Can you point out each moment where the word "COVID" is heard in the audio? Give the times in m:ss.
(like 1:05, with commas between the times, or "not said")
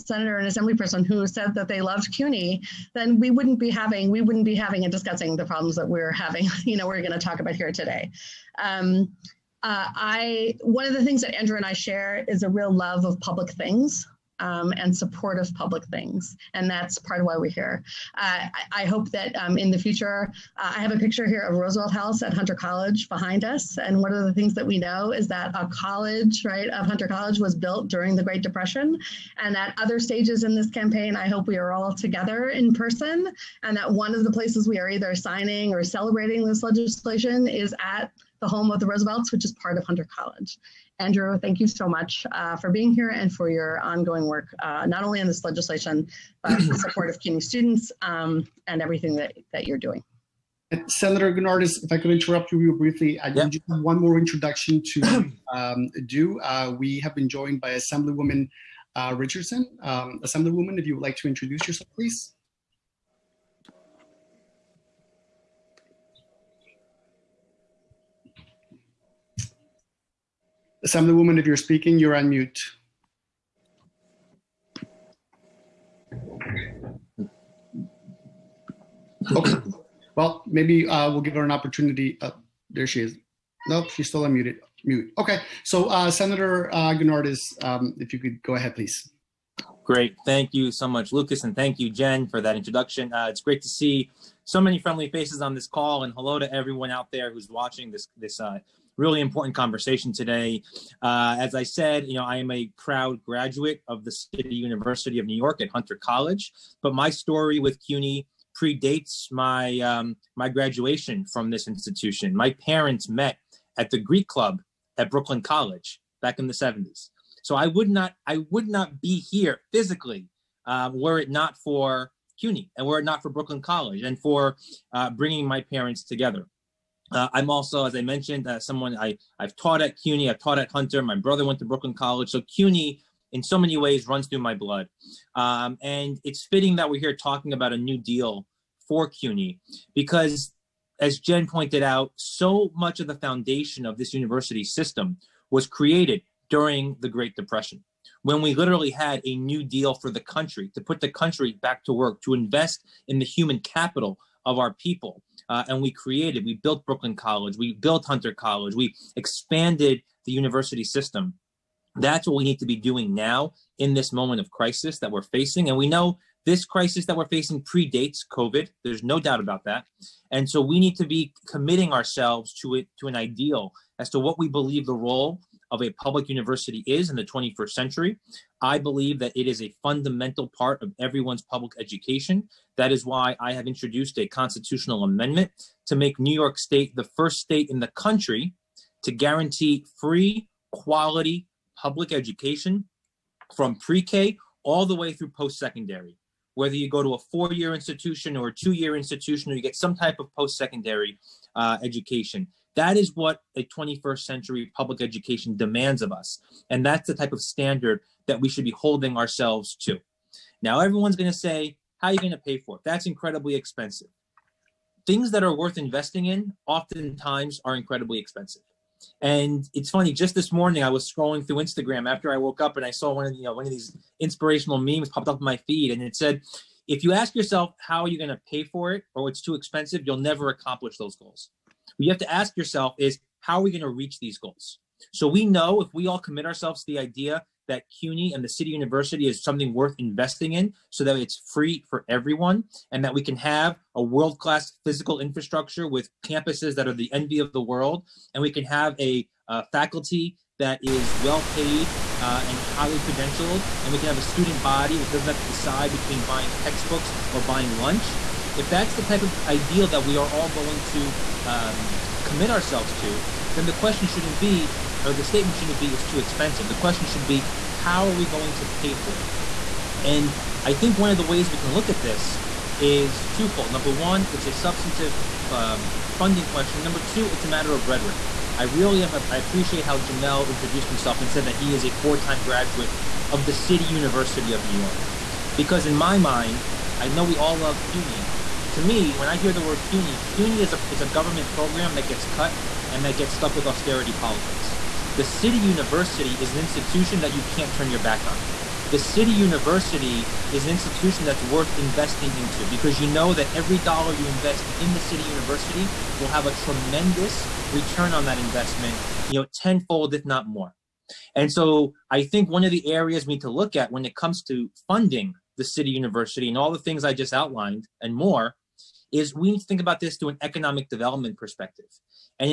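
2:48.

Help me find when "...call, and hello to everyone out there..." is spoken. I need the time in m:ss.
1:35.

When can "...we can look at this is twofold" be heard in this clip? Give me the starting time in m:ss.
4:31.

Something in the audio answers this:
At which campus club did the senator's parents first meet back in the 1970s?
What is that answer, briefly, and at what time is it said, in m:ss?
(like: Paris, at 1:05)
the Greek Club, at 1:53.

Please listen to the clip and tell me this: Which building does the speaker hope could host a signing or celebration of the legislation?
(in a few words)
Roosevelt House.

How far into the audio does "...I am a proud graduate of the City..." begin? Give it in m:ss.
1:42.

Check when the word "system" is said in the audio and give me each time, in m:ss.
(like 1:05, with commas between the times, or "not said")
2:24, 2:40.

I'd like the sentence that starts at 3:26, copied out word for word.
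And that's the type of standard that we should be holding ourselves to.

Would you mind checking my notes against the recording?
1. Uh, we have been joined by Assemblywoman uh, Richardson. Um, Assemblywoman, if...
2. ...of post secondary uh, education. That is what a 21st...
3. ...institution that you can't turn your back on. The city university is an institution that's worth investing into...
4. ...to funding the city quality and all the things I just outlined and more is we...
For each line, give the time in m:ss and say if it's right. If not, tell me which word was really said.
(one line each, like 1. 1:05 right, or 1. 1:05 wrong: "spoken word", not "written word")
1. 0:56 right
2. 3:20 right
3. 4:56 right
4. 5:14 wrong: "university", not "quality".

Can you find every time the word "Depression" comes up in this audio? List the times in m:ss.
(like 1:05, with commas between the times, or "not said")
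0:28, 2:27.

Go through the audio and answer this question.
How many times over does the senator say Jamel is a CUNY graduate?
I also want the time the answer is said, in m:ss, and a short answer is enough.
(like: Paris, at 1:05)
4, at 4:41.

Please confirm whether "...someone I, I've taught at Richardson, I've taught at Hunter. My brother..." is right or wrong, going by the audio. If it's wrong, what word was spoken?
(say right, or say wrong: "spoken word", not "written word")
wrong: "CUNY", not "Richardson".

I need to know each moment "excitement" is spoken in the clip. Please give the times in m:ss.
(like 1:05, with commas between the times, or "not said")
not said.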